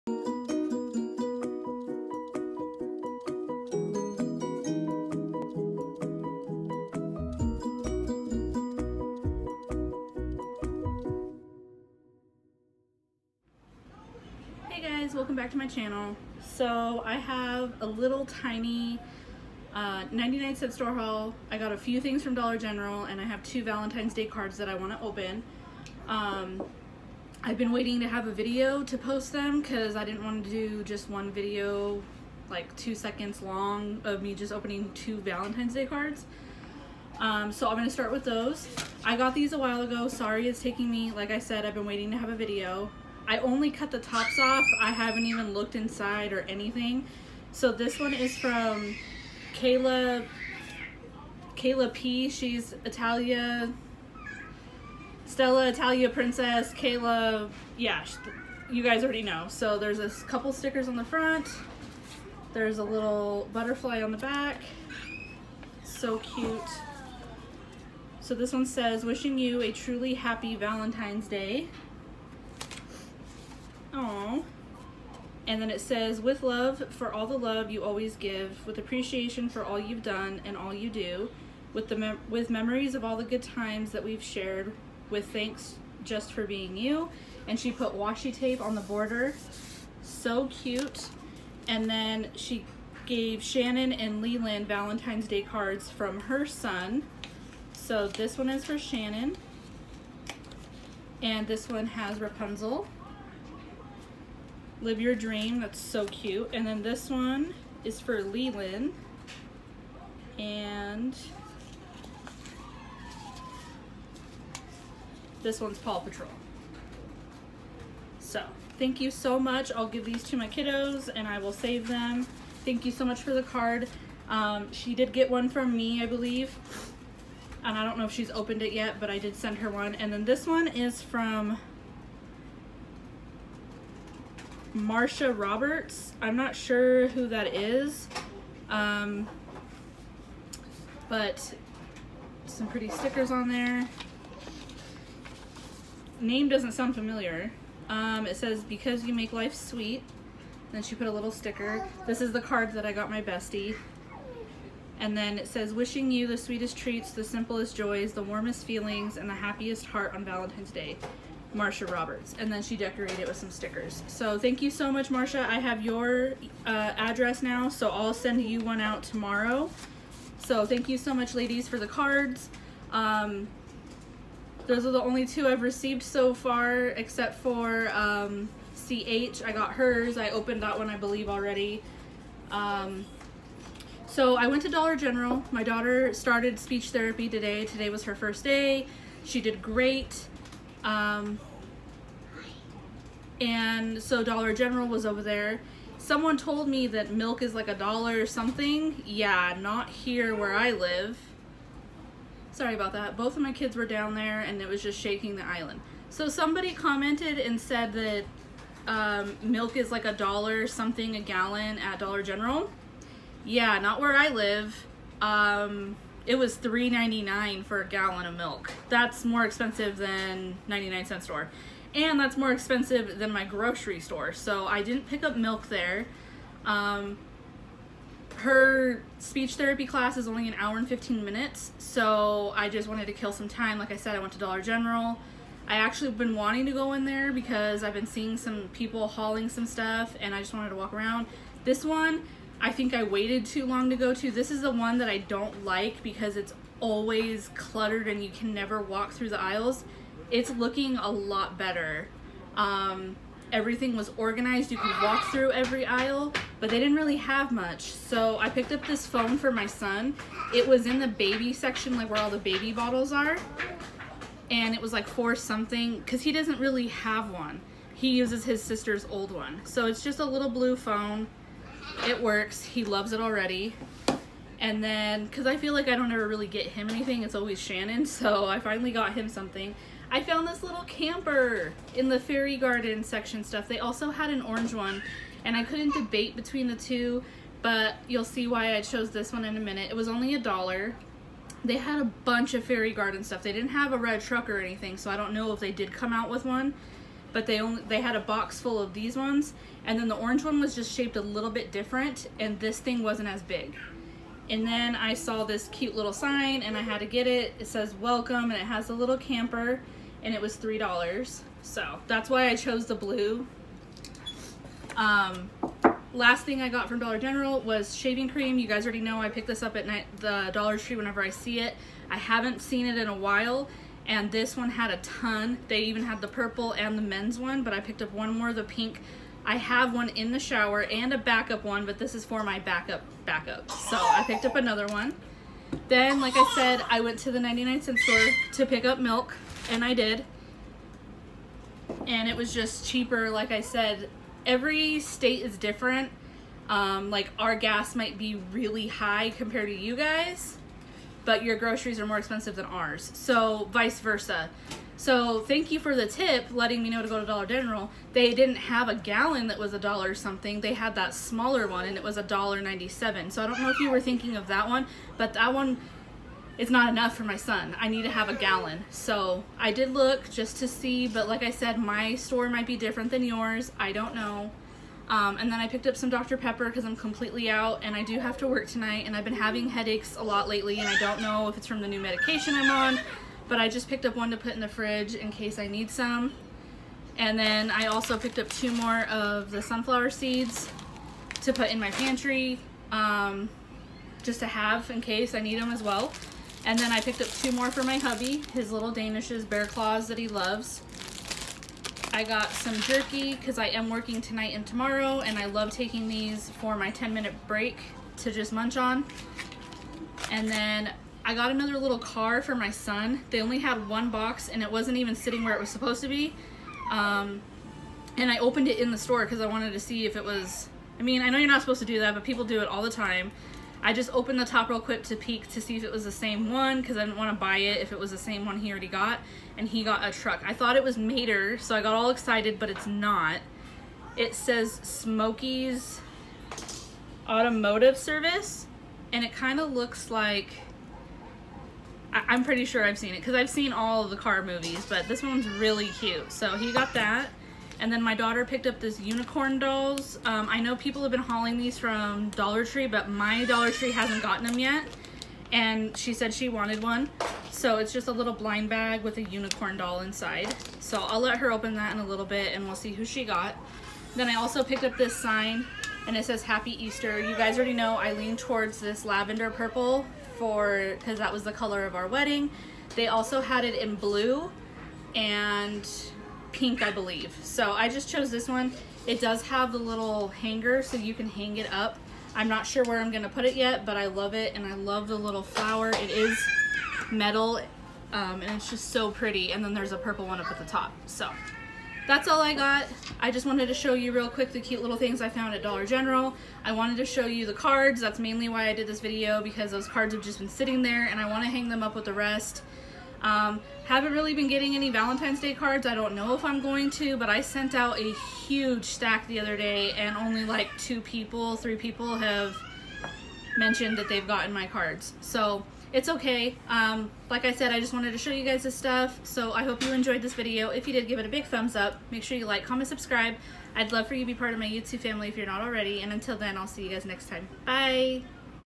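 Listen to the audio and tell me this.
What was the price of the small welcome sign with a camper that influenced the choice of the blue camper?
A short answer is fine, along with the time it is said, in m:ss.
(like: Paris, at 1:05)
3 dollars, at 5:10.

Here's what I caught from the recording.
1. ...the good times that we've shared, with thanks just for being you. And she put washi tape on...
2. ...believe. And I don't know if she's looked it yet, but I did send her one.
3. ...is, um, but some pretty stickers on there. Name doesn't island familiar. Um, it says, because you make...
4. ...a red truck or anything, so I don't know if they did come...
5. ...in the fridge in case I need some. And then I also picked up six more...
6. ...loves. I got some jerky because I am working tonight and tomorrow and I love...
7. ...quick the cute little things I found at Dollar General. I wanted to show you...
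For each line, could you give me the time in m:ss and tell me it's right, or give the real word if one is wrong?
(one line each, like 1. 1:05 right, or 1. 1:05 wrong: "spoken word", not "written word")
1. 1:23 right
2. 2:06 wrong: "opened", not "looked"
3. 2:17 wrong: "sound", not "island"
4. 4:53 right
5. 6:24 wrong: "two", not "six"
6. 6:40 right
7. 8:14 right.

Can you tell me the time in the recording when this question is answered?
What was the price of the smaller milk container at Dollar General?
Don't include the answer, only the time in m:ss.
6:02.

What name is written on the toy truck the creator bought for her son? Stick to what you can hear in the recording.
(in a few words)
Smokey's Automotive Service.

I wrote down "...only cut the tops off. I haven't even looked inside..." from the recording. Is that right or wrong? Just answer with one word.
right.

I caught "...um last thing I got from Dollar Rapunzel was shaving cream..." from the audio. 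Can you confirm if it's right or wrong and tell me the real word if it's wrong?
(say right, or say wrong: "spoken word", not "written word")
wrong: "General", not "Rapunzel".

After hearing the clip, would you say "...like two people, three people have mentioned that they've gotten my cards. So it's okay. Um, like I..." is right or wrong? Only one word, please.
right.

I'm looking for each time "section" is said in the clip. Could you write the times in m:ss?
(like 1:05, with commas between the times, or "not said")
4:21, 4:43.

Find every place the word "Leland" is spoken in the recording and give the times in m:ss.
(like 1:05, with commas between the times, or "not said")
1:34, 1:48.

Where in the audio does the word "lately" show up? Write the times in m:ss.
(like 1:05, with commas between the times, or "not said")
6:20.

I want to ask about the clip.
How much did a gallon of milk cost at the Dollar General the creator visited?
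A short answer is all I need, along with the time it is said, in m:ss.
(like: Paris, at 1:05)
$3.99, at 3:36.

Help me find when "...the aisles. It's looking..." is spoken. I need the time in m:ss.
4:09.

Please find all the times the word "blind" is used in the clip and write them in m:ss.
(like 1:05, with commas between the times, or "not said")
7:38.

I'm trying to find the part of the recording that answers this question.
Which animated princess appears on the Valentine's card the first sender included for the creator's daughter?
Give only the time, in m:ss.
1:42.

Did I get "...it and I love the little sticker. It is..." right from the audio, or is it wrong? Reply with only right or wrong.
wrong.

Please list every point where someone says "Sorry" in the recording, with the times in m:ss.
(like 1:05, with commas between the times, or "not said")
0:40, 3:22.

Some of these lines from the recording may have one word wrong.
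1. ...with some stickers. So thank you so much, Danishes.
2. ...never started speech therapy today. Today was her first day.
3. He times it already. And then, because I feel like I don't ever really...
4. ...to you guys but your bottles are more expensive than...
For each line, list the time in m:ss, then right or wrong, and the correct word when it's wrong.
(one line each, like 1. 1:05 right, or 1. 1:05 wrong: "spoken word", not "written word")
1. 2:43 wrong: "Marsha", not "Danishes"
2. 3:05 wrong: "daughter", not "never"
3. 4:32 wrong: "loves", not "times"
4. 5:49 wrong: "groceries", not "bottles".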